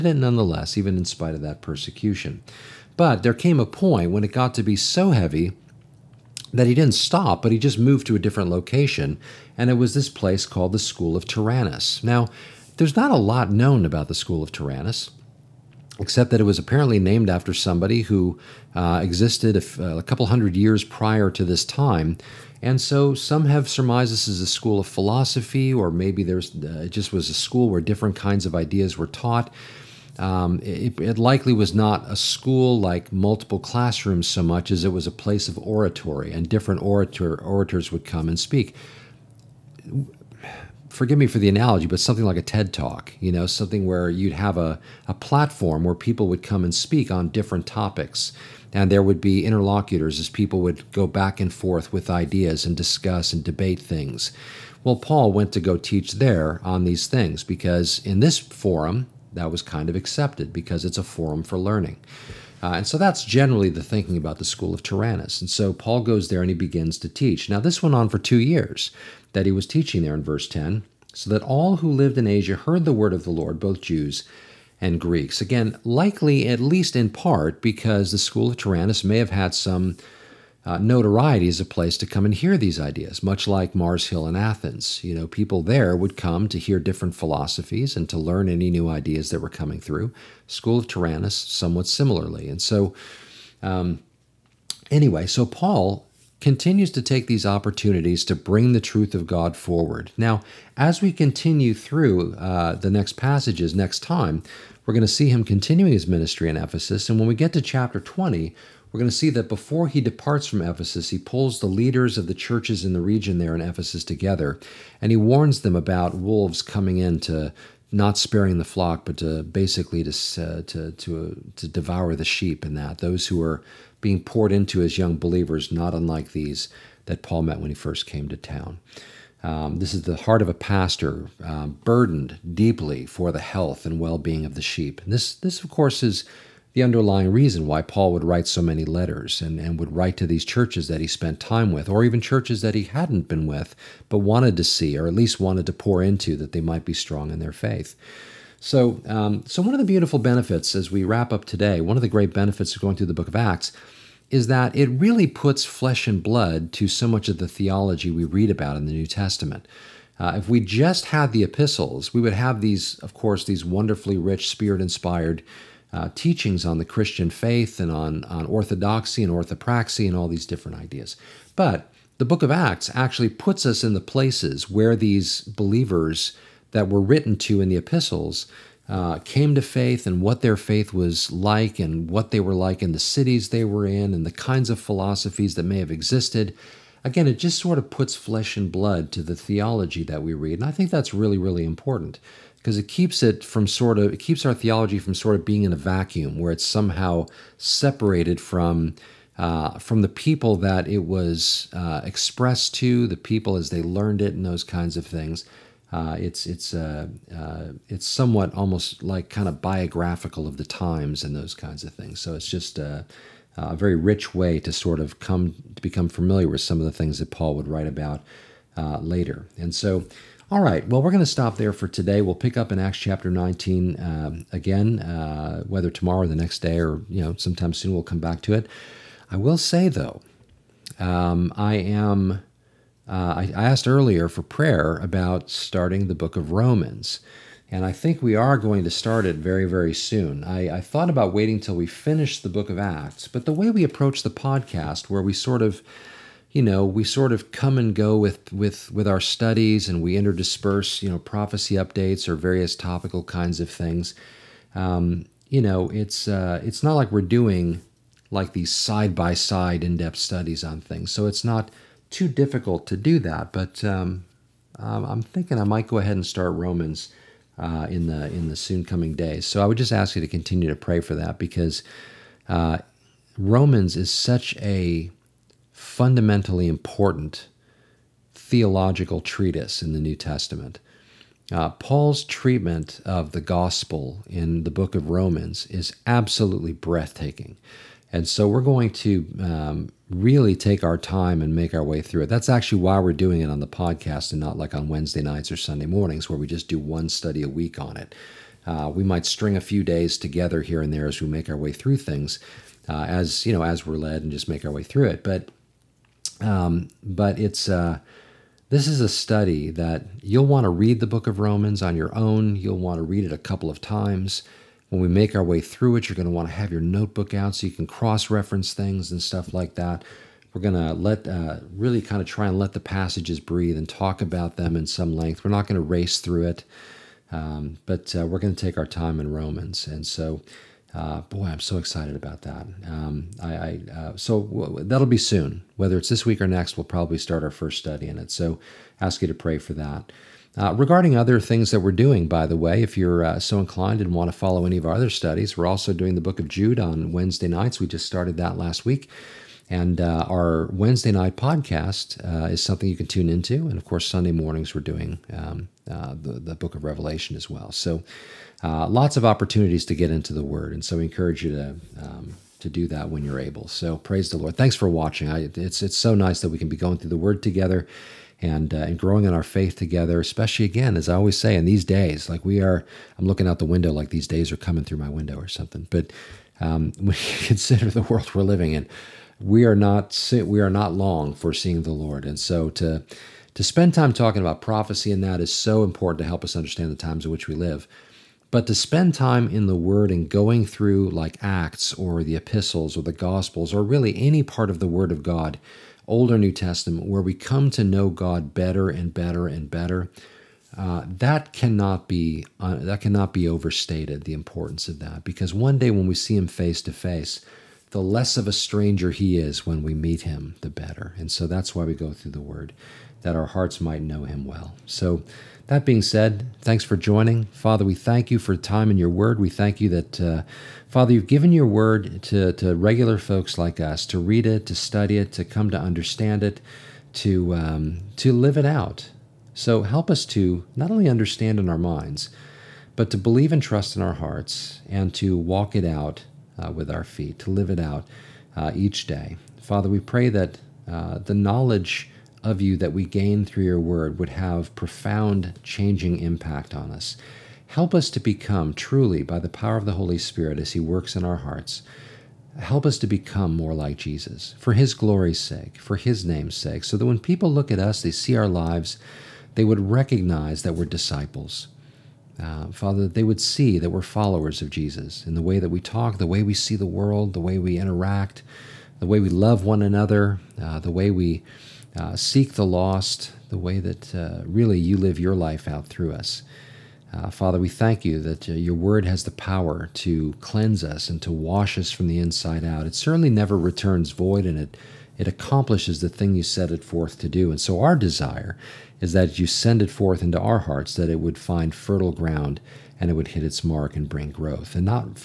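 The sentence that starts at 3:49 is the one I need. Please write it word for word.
I will say though, um, I am uh, I, I asked earlier for prayer about starting the book of Romans.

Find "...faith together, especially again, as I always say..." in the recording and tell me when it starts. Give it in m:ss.
6:09.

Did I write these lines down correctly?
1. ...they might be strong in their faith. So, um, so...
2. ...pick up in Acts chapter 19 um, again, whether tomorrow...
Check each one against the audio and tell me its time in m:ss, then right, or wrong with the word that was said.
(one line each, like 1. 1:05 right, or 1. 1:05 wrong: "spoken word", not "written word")
1. 2:26 right
2. 3:42 right.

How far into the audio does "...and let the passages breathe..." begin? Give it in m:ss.
5:22.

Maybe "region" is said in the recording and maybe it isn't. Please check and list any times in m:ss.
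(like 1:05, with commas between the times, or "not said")
1:53.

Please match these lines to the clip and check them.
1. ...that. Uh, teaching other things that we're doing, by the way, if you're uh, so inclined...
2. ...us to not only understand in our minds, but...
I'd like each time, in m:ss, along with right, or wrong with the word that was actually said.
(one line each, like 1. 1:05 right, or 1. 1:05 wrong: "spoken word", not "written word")
1. 5:39 wrong: "regarding", not "teaching"
2. 7:10 right.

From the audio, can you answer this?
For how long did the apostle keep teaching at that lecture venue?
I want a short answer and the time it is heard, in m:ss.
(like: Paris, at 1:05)
2 years, at 1:08.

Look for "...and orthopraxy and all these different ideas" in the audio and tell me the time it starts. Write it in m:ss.
2:49.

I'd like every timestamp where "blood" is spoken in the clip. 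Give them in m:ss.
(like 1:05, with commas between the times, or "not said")
2:36, 3:08.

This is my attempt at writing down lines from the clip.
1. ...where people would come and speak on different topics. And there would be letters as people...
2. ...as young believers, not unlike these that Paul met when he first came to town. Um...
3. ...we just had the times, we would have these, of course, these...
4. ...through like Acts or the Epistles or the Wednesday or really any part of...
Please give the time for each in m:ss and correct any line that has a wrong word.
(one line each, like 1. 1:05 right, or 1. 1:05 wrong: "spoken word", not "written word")
1. 0:45 wrong: "interlocutors", not "letters"
2. 2:04 right
3. 2:40 wrong: "epistles", not "times"
4. 6:30 wrong: "Gospels", not "Wednesday".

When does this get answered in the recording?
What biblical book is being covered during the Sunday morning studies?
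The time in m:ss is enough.
5:56.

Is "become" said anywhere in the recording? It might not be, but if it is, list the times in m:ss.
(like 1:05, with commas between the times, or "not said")
3:35, 7:28, 7:33.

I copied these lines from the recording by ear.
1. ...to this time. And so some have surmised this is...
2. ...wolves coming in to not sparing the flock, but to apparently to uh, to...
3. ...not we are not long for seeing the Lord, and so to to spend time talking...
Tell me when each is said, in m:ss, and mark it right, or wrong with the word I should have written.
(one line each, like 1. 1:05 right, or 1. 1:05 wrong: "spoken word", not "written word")
1. 0:21 right
2. 1:56 wrong: "basically", not "apparently"
3. 6:19 right.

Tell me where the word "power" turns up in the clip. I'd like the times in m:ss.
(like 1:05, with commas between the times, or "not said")
7:29, 7:59.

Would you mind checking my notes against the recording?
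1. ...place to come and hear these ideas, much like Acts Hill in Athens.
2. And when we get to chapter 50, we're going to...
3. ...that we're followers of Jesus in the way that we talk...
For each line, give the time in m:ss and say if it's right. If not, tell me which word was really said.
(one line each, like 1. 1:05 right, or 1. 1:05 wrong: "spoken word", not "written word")
1. 1:21 wrong: "Mars", not "Acts"
2. 1:47 wrong: "20", not "50"
3. 7:43 right.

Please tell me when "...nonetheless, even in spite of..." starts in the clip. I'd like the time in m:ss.
0:00.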